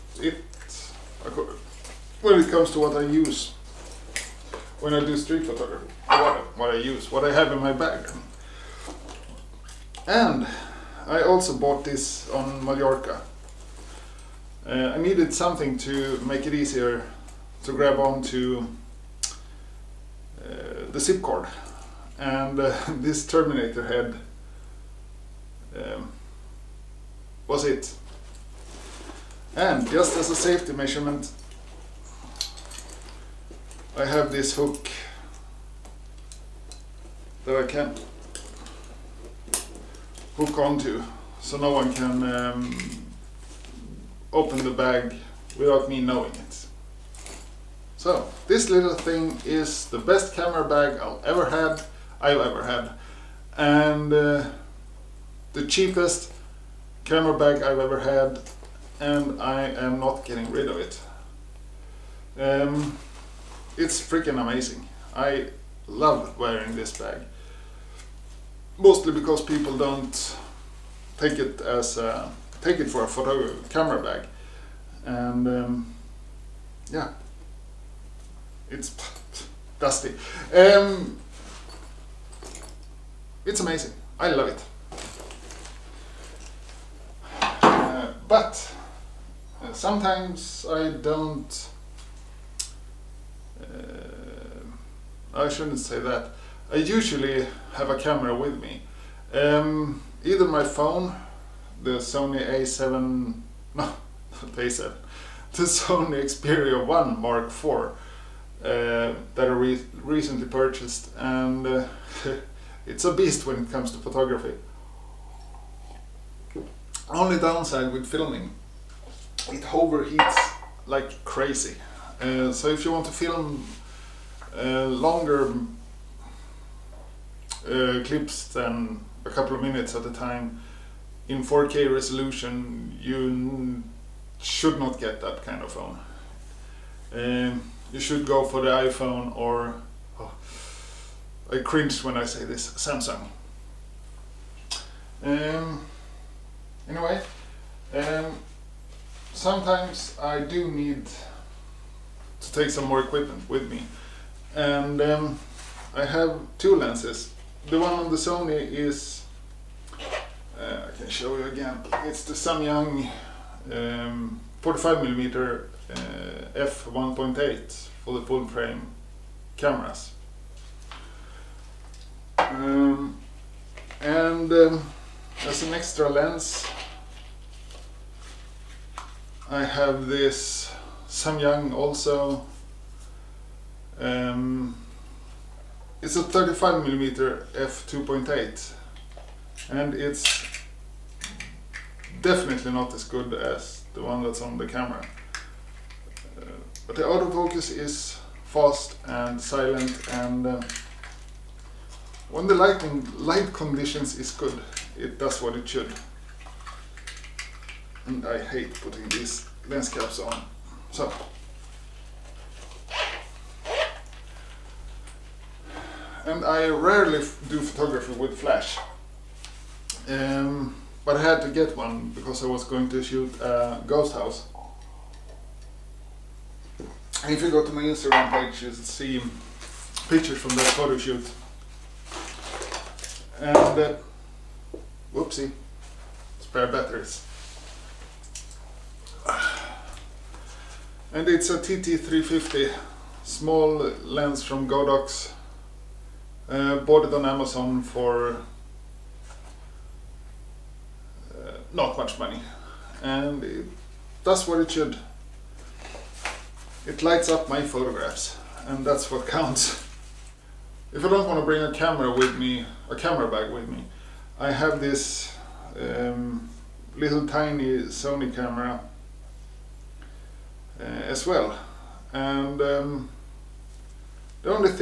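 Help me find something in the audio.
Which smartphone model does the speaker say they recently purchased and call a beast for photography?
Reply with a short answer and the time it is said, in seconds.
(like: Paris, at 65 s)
Sony Xperia 1 Mark IV, at 105 s.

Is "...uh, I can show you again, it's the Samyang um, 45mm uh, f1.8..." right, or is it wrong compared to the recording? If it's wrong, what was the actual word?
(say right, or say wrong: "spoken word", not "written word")
right.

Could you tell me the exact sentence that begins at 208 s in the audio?
And I hate putting these lens caps on.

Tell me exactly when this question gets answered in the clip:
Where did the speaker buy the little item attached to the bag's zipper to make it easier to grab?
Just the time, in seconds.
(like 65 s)
12 s.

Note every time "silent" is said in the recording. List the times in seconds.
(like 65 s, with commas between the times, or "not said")
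199 s.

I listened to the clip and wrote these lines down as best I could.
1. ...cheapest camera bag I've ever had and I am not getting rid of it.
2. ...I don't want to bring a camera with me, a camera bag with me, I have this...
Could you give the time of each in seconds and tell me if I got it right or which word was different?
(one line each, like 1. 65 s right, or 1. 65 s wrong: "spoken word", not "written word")
1. 55 s right
2. 261 s right.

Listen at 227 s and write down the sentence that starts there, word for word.
If you go to my Instagram page, you'll see pictures from that photo shoot.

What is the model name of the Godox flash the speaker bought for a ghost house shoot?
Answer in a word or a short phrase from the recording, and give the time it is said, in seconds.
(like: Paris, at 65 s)
TT350, at 241 s.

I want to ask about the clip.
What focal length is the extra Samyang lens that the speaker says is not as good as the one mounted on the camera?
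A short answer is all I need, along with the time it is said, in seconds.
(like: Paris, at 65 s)
35mm, at 186 s.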